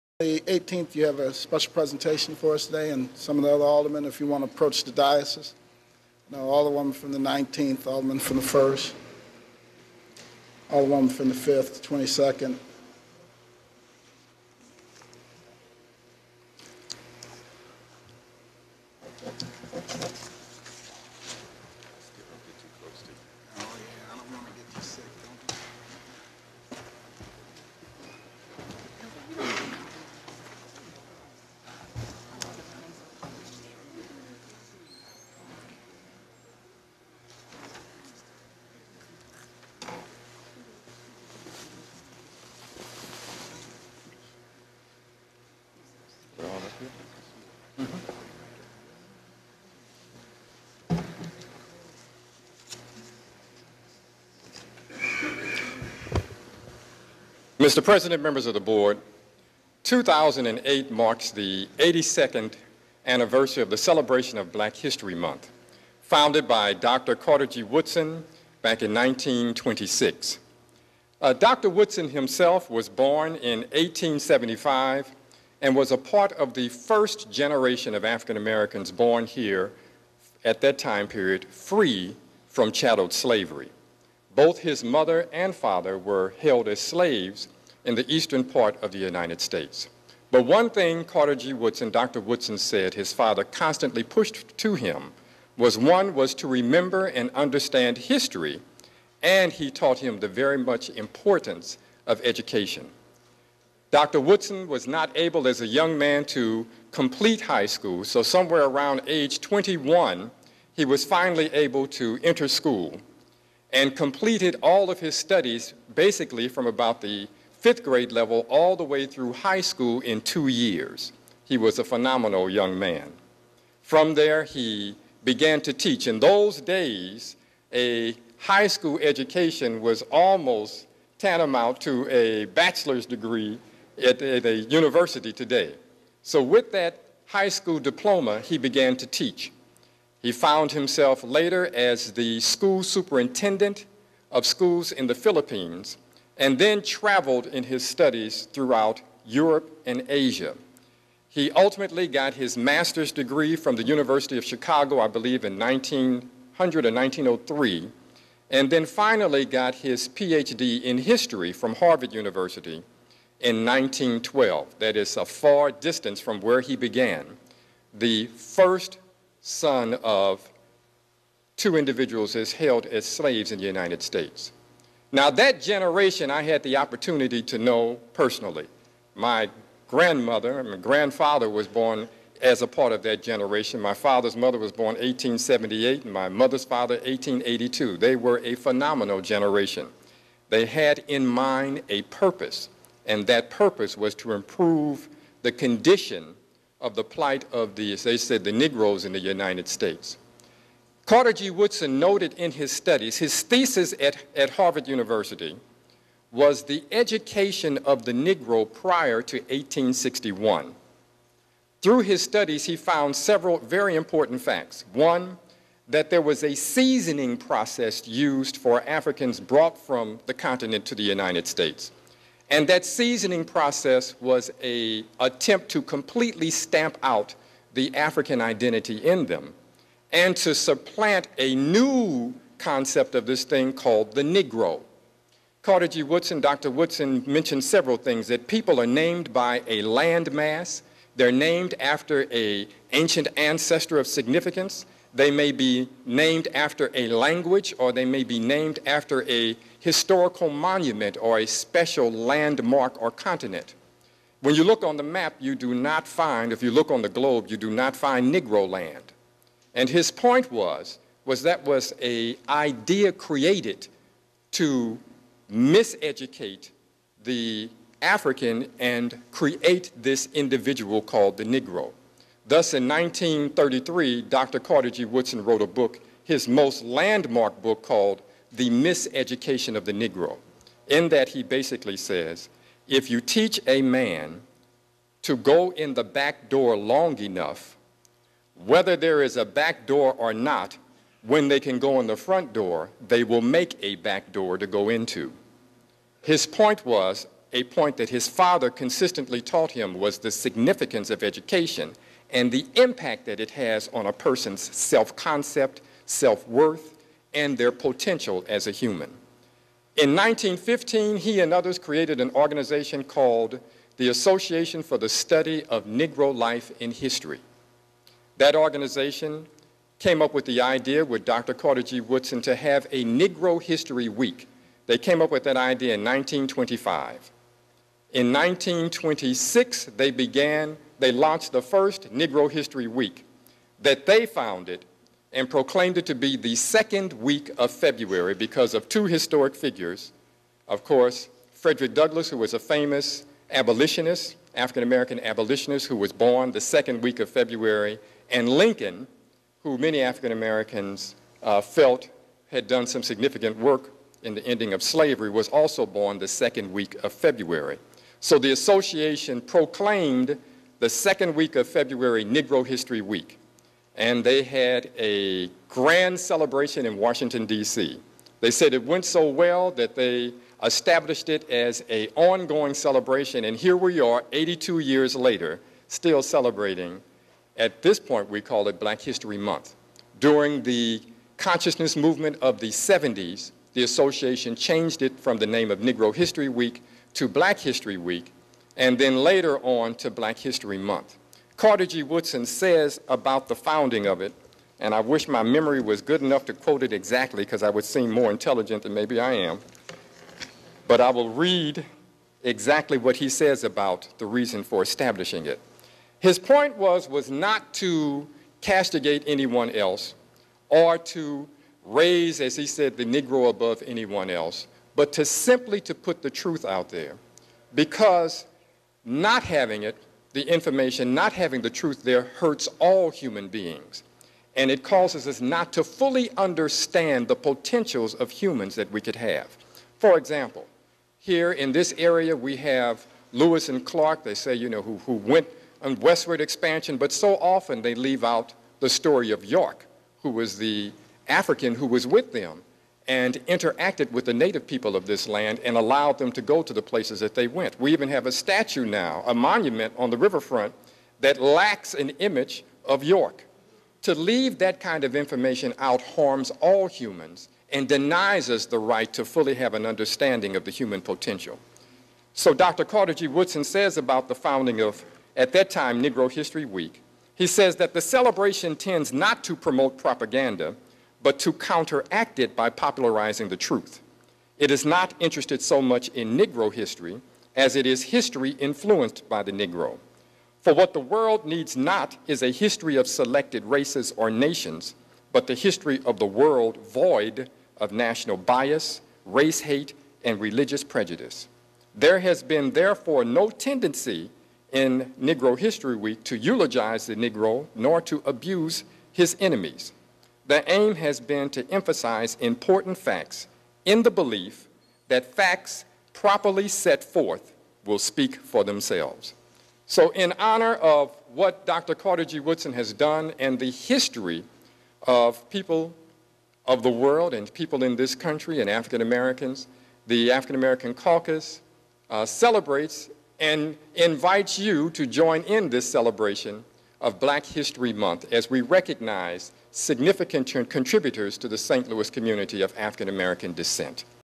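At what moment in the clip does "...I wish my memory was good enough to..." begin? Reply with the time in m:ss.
6:34.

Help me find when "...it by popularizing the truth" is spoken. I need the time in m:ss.
7:52.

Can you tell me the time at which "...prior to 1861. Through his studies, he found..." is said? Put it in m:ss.
3:28.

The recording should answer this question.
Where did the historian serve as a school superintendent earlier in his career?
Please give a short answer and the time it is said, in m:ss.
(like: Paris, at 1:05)
The Philippines, at 2:25.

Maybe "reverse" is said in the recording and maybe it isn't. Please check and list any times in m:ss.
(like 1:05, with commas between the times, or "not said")
not said.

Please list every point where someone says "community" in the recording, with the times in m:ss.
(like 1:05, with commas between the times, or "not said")
8:52.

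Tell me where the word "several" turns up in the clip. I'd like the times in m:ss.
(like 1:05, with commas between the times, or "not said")
3:33, 3:57.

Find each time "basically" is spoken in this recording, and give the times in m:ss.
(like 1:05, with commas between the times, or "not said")
1:55, 4:41.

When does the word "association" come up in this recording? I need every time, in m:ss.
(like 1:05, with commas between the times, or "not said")
5:14, 5:58, 6:23.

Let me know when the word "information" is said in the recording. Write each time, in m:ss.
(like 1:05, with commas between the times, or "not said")
7:00, 7:35.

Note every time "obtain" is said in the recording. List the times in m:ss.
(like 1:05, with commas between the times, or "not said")
not said.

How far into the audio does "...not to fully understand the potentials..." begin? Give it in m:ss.
7:05.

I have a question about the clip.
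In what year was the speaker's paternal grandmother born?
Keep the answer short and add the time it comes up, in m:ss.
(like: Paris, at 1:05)
1878, at 3:04.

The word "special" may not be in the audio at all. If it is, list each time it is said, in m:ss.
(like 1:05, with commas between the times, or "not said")
0:01, 4:11.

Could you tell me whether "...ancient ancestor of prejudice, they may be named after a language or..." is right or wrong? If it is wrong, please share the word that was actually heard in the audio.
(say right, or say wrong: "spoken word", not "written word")
wrong: "significance", not "prejudice".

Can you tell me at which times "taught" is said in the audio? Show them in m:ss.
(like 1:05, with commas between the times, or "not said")
1:39, 4:59.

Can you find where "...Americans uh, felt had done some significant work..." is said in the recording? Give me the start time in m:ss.
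5:50.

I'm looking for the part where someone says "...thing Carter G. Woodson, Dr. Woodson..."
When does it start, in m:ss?
1:30.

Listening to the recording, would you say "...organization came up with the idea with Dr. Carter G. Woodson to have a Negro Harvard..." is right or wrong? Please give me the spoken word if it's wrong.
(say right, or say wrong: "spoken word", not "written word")
wrong: "History", not "Harvard".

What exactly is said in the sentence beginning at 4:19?
And his point was, was that was a idea created to miseducate the African and create this individual called the Negro.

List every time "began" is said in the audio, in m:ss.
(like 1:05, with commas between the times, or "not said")
2:05, 2:18, 2:46, 5:30.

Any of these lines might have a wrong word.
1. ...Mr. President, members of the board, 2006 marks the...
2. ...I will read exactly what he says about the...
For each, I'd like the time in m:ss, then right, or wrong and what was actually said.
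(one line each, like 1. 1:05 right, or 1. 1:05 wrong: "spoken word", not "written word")
1. 0:57 wrong: "2008", not "2006"
2. 6:41 right.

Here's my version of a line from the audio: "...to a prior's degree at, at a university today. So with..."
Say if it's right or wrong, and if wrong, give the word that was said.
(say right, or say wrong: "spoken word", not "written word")
wrong: "bachelor", not "prior".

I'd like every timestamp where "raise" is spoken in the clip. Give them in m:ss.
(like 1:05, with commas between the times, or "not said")
6:51.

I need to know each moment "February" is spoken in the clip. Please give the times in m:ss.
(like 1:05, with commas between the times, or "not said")
5:37, 5:47, 5:57, 6:01.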